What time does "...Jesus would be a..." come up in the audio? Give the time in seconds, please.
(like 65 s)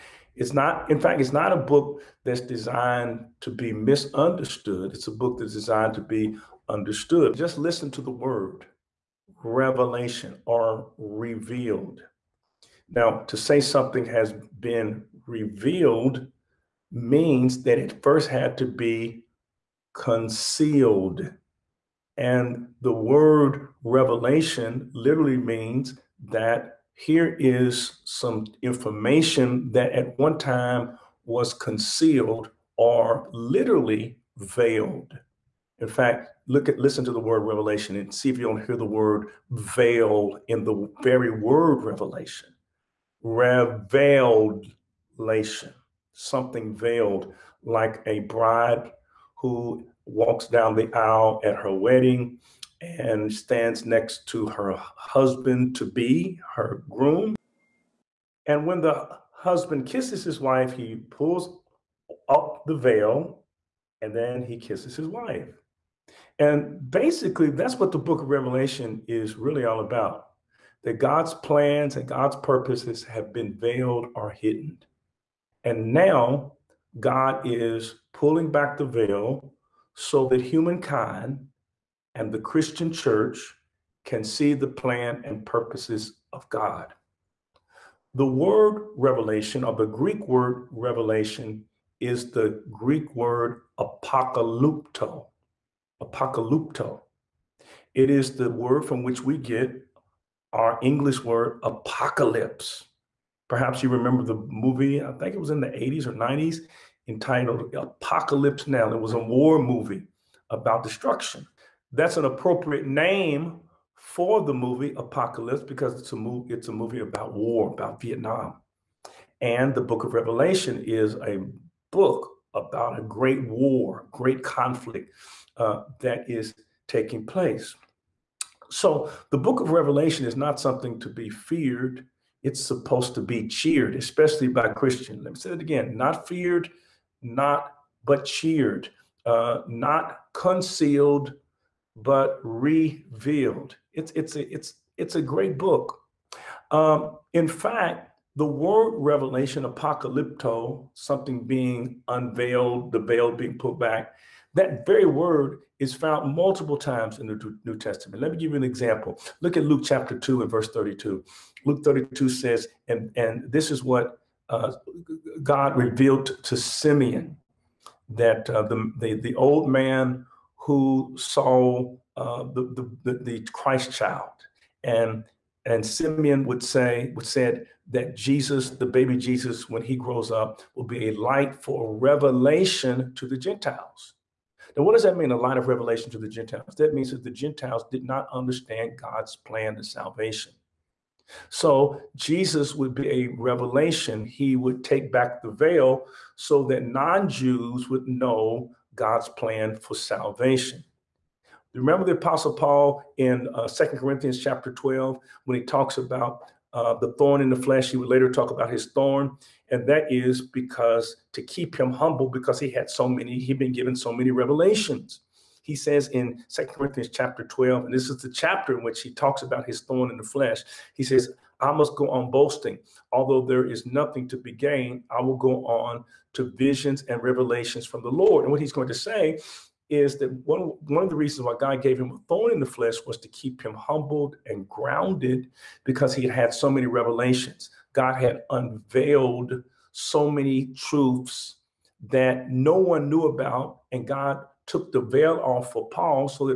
192 s.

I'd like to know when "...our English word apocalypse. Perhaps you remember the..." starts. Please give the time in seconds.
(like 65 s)
100 s.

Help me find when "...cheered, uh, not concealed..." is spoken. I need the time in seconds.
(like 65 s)
138 s.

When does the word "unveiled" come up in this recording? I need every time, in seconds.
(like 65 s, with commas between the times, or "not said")
152 s, 238 s.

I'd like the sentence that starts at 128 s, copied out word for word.
So the book of Revelation is not something to be feared it's supposed to be cheered, especially by Christian.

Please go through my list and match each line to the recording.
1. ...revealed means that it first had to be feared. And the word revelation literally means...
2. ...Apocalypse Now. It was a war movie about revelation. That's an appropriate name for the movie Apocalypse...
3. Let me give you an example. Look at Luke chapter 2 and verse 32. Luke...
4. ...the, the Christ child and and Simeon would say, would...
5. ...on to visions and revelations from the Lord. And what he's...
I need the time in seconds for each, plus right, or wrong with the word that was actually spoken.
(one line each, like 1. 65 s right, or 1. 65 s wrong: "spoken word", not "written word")
1. 15 s wrong: "concealed", not "feared"
2. 107 s wrong: "destruction", not "revelation"
3. 158 s right
4. 173 s right
5. 225 s right.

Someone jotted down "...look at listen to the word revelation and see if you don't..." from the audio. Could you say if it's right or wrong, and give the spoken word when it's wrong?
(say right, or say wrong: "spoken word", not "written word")
right.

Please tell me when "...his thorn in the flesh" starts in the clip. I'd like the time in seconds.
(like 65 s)
219 s.